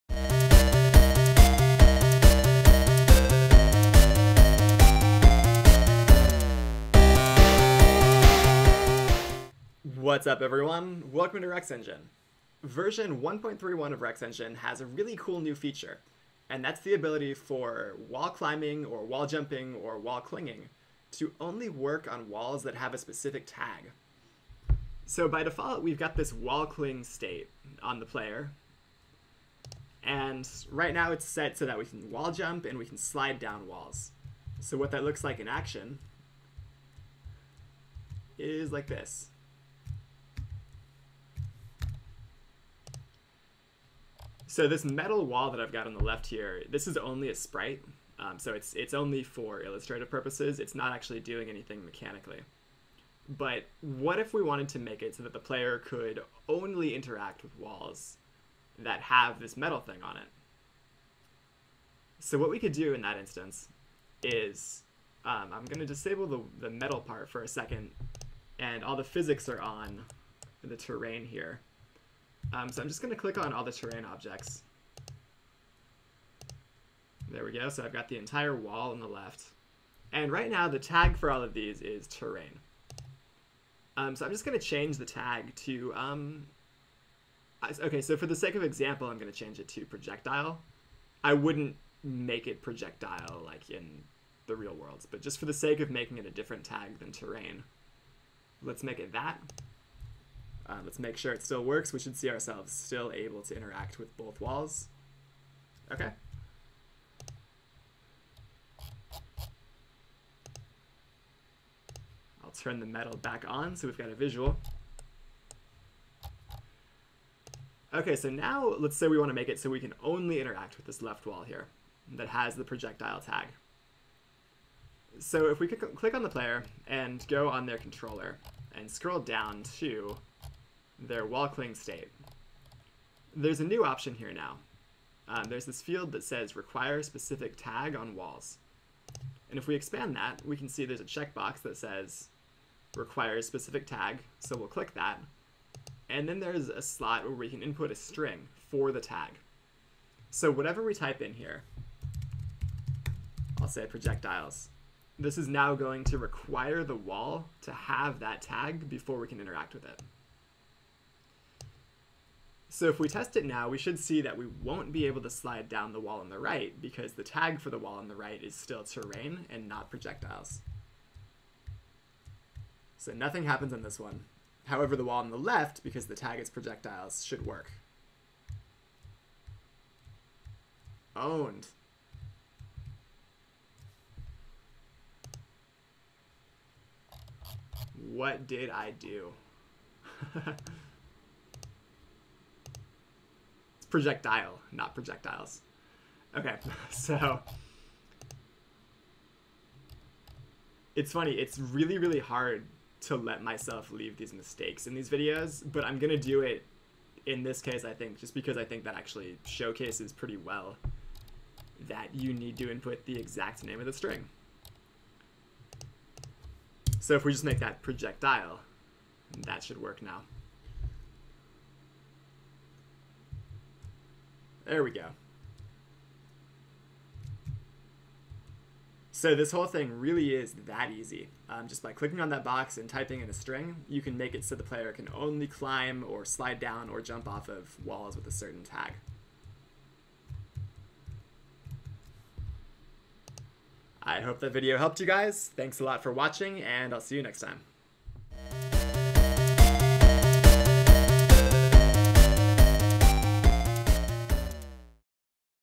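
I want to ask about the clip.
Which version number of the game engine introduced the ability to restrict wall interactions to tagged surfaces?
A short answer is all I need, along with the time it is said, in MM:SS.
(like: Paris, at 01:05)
1.31, at 00:12.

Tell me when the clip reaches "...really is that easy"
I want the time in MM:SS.
03:49.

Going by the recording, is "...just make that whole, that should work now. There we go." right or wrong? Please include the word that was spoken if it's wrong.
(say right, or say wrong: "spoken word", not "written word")
wrong: "projectile", not "whole".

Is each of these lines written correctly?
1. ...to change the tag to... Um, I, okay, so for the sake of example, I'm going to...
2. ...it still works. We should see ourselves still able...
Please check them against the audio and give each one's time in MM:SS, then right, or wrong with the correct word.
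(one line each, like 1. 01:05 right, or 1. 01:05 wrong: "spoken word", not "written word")
1. 01:24 right
2. 01:41 right.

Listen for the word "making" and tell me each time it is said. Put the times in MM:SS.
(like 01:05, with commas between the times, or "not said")
01:35.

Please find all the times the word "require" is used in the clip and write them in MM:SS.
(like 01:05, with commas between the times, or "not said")
02:16, 02:22, 02:36.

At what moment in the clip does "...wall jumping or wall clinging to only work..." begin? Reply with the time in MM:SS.
00:19.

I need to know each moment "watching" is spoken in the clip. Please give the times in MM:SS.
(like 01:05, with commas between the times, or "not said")
04:06.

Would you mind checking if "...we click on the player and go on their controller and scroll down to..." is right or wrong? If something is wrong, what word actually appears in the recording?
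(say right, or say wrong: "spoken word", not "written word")
right.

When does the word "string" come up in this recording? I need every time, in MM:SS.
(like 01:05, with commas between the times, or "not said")
02:27, 03:33, 03:53.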